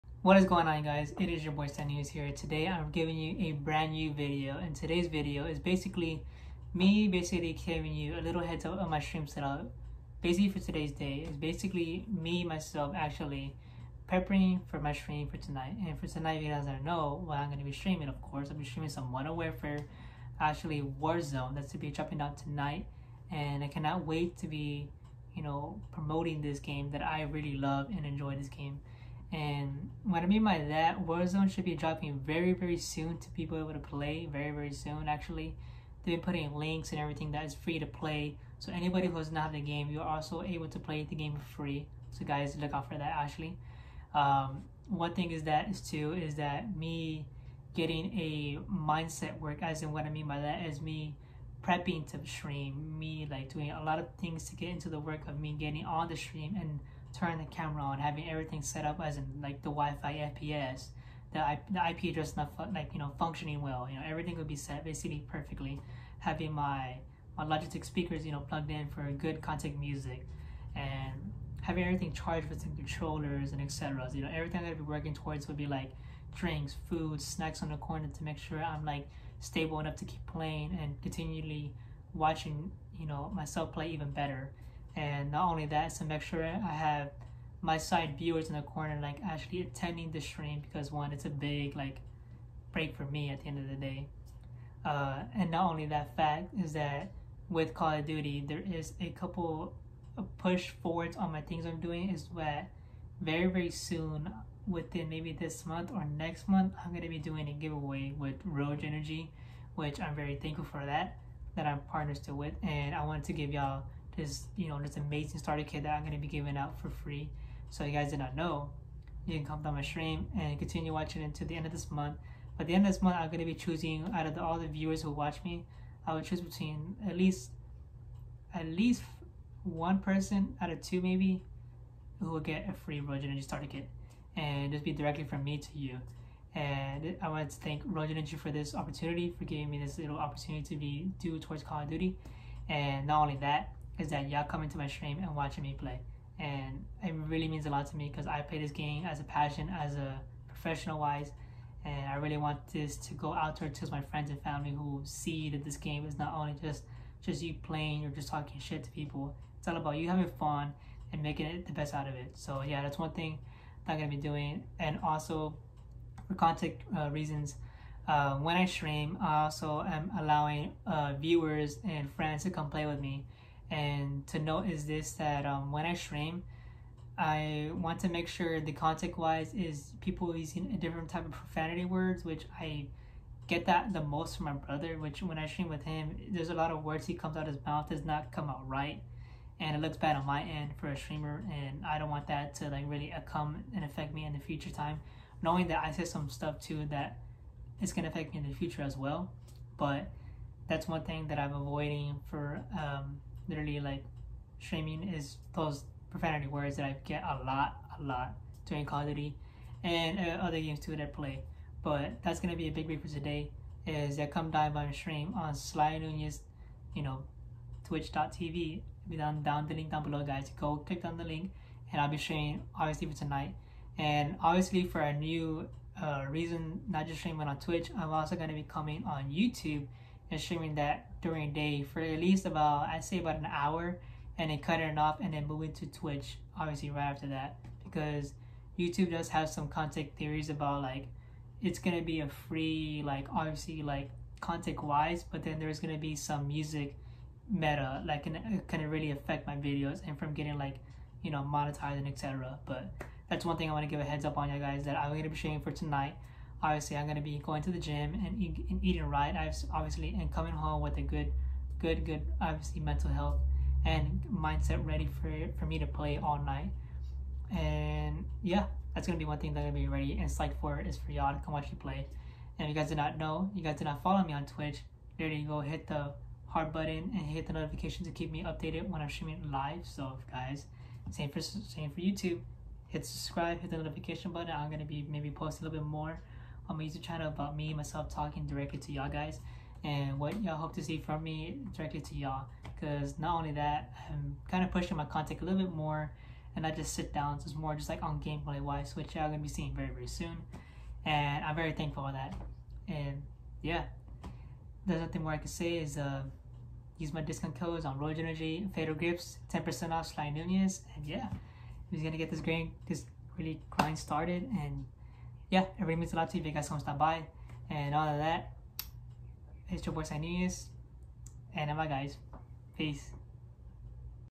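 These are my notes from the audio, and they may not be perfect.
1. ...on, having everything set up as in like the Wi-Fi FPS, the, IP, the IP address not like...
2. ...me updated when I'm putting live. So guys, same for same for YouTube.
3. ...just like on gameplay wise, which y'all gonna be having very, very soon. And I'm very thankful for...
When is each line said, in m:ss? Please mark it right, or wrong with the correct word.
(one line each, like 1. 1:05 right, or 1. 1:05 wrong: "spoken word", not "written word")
1. 0:57 right
2. 4:38 wrong: "streaming", not "putting"
3. 4:57 wrong: "seeing", not "having".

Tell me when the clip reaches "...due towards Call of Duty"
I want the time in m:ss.
2:21.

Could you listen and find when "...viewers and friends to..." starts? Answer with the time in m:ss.
2:51.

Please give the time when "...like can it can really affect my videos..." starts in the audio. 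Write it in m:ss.
4:08.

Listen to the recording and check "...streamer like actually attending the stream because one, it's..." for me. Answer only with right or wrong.
wrong.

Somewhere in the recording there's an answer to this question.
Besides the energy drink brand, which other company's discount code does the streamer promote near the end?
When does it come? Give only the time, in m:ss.
5:08.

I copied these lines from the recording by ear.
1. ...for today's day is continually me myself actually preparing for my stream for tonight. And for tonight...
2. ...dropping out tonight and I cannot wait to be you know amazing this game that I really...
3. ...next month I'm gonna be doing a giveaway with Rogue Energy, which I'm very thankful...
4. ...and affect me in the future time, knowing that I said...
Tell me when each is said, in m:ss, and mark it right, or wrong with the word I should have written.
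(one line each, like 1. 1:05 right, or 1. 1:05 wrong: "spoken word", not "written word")
1. 0:10 wrong: "basically", not "continually"
2. 0:21 wrong: "promoting", not "amazing"
3. 1:46 right
4. 3:13 right.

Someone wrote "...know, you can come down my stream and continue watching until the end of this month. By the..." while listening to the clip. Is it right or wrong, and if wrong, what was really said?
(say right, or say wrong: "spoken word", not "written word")
right.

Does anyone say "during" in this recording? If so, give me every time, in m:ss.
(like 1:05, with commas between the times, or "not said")
3:28, 3:51.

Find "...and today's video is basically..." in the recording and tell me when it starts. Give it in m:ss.
0:04.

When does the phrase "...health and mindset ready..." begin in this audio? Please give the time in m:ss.
4:23.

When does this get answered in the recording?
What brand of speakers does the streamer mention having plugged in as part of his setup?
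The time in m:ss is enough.
1:07.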